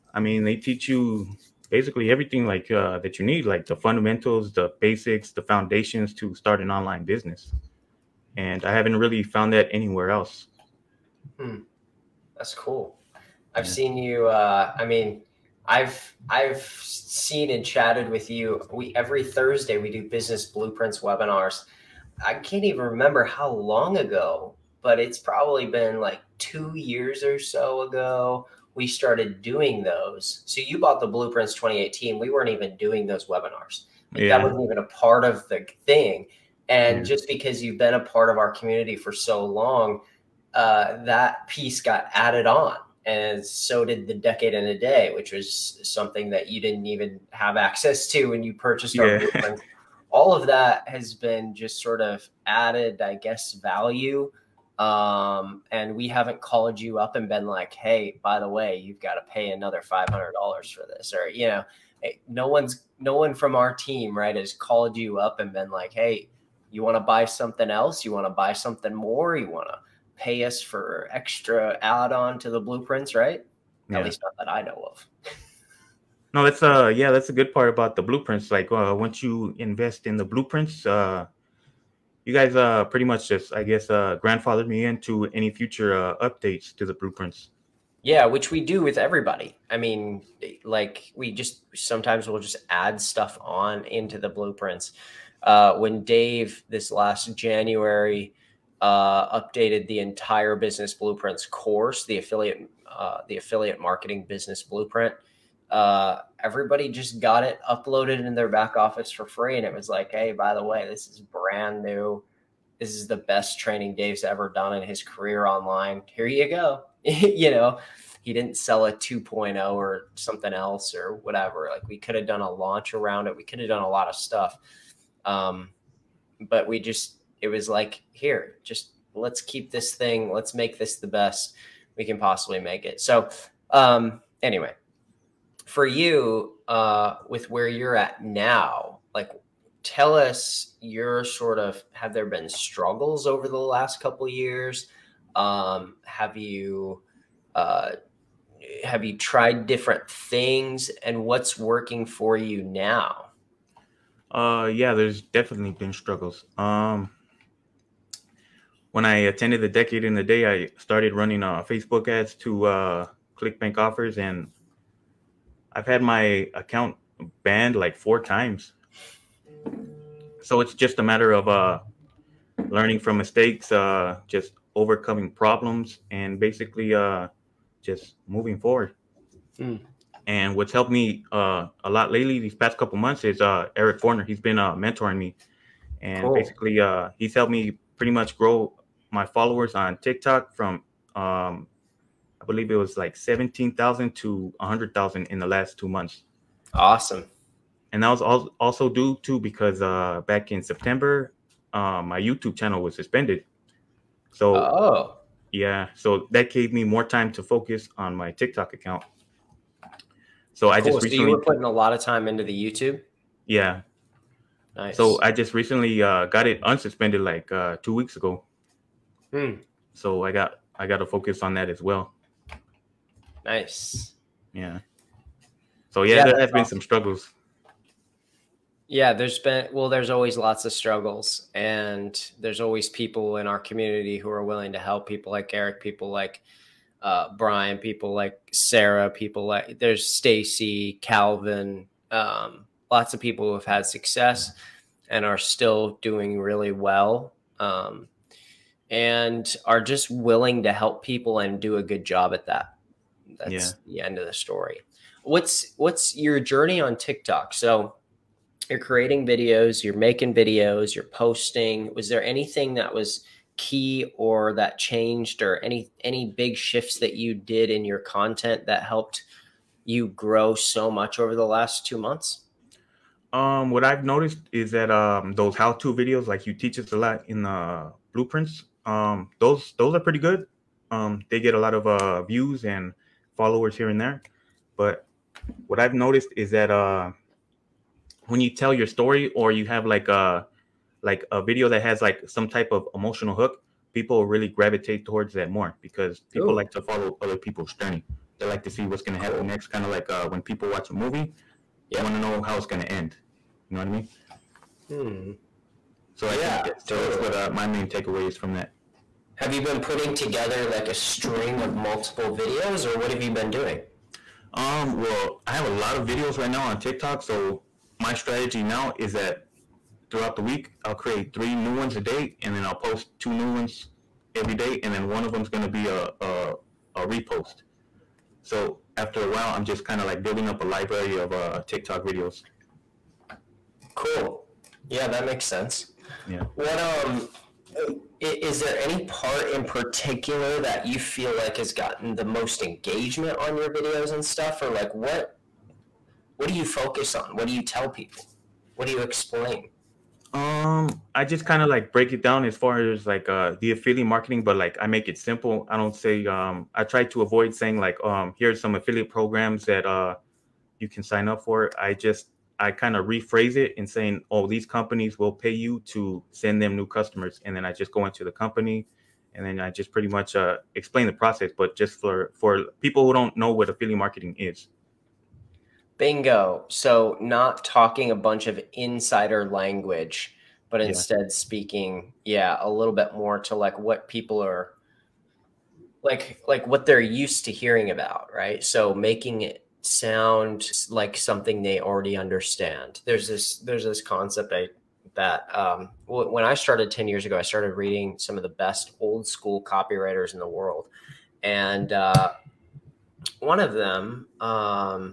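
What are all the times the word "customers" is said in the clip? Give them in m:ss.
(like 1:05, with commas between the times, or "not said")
6:06.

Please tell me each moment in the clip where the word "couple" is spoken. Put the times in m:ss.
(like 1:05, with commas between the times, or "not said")
2:23, 3:02.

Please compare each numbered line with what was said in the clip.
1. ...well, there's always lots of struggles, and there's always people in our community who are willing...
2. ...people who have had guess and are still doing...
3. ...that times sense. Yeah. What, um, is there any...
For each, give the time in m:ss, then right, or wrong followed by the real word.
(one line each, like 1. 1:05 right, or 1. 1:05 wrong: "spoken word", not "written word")
1. 3:49 right
2. 4:03 wrong: "success", not "guess"
3. 5:35 wrong: "makes", not "times".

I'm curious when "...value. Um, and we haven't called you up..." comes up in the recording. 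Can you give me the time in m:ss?
0:53.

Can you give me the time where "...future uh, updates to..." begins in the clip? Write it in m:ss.
1:25.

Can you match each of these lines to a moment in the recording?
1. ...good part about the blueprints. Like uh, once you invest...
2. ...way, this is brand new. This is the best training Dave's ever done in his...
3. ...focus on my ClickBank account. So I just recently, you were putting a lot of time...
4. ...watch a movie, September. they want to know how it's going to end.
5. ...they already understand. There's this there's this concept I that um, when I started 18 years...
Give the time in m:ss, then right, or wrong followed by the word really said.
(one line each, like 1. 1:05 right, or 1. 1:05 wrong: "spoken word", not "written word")
1. 1:17 right
2. 1:50 right
3. 3:27 wrong: "TikTok", not "ClickBank"
4. 5:00 wrong: "Yeah", not "September"
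5. 6:31 wrong: "10", not "18".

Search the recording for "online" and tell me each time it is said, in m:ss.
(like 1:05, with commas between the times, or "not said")
0:06, 1:55.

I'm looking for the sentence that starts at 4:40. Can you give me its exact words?
Um, they get a lot of uh, views and followers here and there.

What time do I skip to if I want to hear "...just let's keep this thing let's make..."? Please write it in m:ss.
2:08.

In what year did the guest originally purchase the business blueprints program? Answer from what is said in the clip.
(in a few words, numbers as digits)
2018.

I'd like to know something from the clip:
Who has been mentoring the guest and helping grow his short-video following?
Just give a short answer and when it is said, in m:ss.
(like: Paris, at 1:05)
Eric Forner, at 3:03.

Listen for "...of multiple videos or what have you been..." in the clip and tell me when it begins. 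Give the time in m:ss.
5:11.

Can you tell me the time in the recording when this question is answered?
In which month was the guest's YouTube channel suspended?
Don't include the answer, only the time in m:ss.
3:20.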